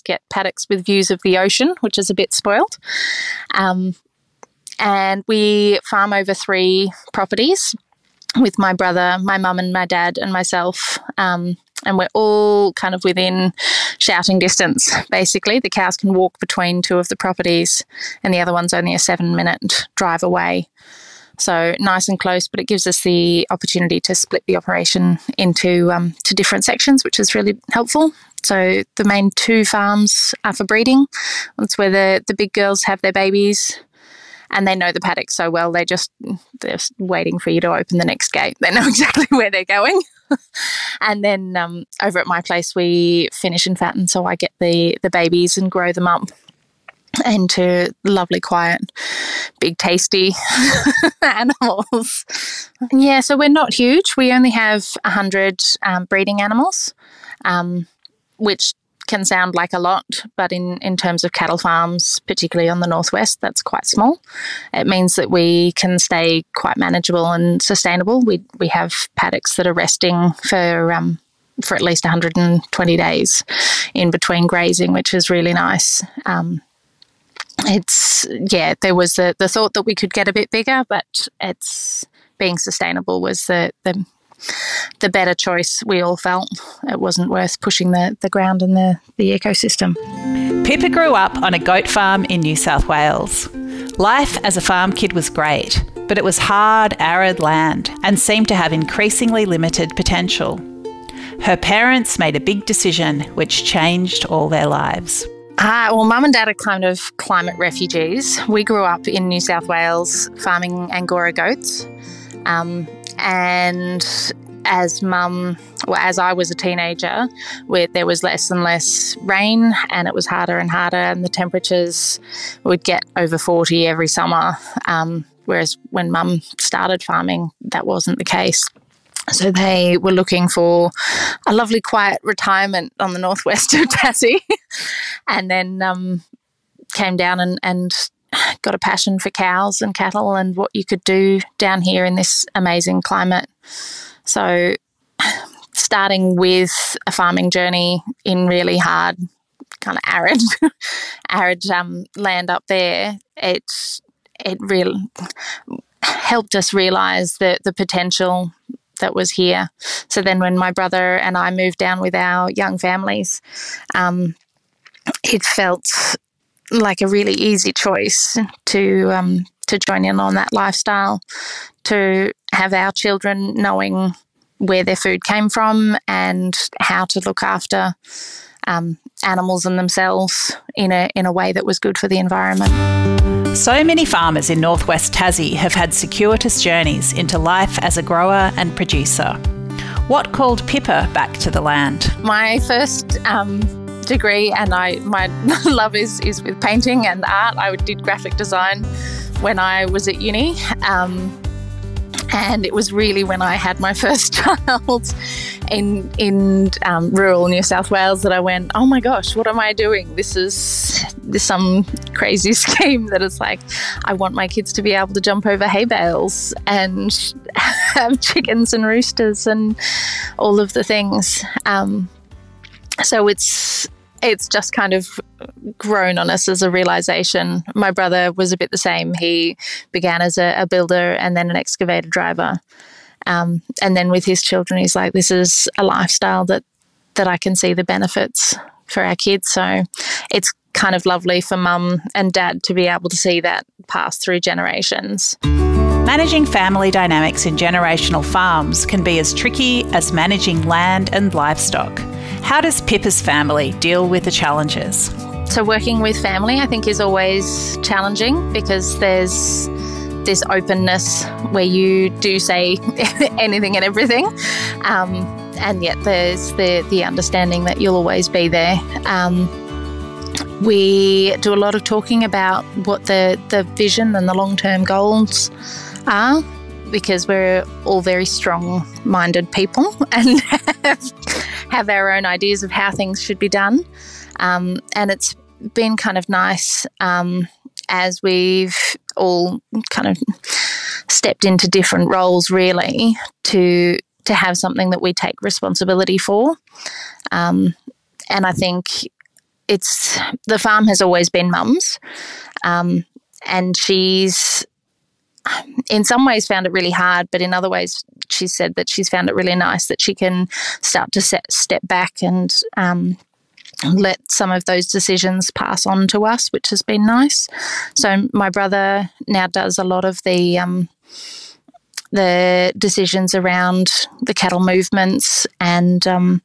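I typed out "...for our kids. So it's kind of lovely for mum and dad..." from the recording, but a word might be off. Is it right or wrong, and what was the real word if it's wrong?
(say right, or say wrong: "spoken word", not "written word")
right.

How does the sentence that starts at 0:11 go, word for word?
Um, and we're all kind of within shouting distance, basically.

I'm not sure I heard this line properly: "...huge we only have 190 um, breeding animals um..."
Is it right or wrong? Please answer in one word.
wrong.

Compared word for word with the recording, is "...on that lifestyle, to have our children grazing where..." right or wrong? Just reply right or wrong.
wrong.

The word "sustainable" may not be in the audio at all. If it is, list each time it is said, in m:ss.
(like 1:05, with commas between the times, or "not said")
1:07, 1:22.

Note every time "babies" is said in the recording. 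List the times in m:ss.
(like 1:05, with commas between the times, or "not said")
0:33, 0:45.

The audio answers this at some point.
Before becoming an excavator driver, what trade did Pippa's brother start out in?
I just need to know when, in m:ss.
3:50.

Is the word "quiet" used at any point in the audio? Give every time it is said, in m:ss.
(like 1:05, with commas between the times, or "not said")
0:48, 2:11.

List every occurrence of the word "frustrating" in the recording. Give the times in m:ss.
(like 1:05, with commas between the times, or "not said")
not said.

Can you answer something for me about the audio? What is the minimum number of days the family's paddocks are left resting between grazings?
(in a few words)
120 days.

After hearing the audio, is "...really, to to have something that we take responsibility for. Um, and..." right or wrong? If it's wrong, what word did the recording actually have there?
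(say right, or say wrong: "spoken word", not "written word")
right.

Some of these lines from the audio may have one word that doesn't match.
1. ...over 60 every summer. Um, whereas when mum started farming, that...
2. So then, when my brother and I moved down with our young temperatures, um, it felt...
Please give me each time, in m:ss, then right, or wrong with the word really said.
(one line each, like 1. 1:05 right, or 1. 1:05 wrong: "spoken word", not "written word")
1. 2:03 wrong: "40", not "60"
2. 2:40 wrong: "families", not "temperatures".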